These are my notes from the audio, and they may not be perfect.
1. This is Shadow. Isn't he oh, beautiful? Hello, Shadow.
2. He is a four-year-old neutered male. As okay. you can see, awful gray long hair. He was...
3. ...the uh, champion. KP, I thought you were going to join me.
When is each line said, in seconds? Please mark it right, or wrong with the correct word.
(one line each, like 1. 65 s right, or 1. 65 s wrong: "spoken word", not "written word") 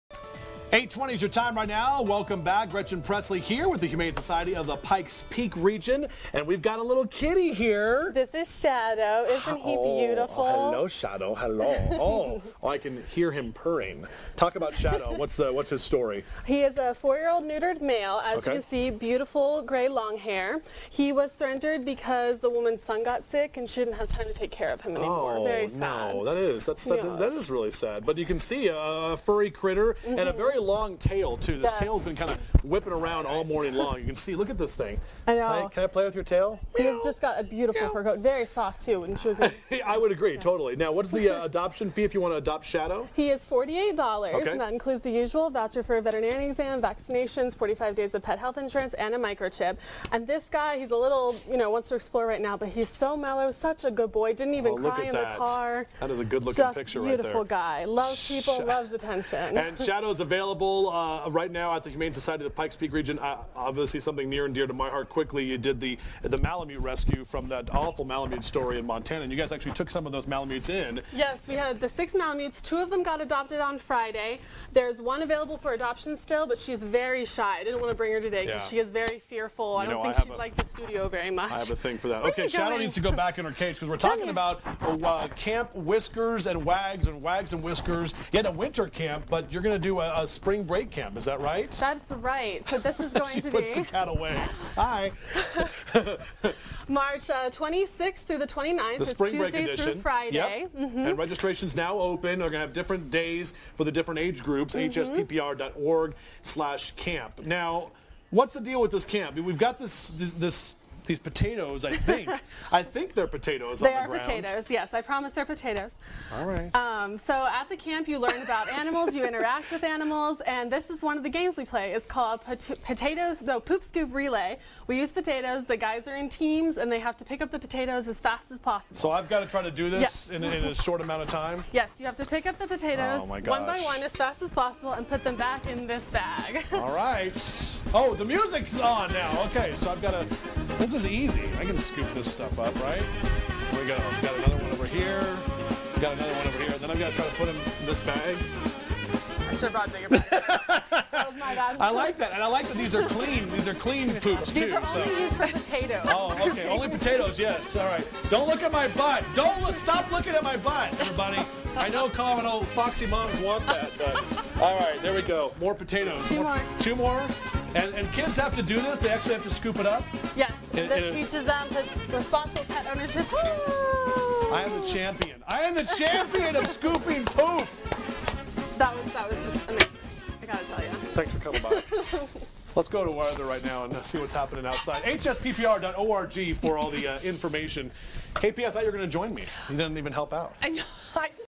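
1. 8 s right
2. 16 s wrong: "beautiful", not "awful"
3. 186 s wrong: "information", not "champion".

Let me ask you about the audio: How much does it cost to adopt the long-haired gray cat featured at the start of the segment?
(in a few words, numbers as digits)
$48.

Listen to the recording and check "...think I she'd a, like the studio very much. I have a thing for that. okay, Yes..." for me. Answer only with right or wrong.
wrong.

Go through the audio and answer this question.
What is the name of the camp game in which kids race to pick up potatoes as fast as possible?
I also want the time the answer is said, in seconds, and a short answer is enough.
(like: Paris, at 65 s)
Poop Scoop Relay, at 123 s.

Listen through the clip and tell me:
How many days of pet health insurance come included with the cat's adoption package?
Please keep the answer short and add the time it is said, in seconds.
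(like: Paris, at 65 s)
45, at 47 s.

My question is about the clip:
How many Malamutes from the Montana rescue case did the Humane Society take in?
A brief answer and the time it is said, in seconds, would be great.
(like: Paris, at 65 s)
6, at 71 s.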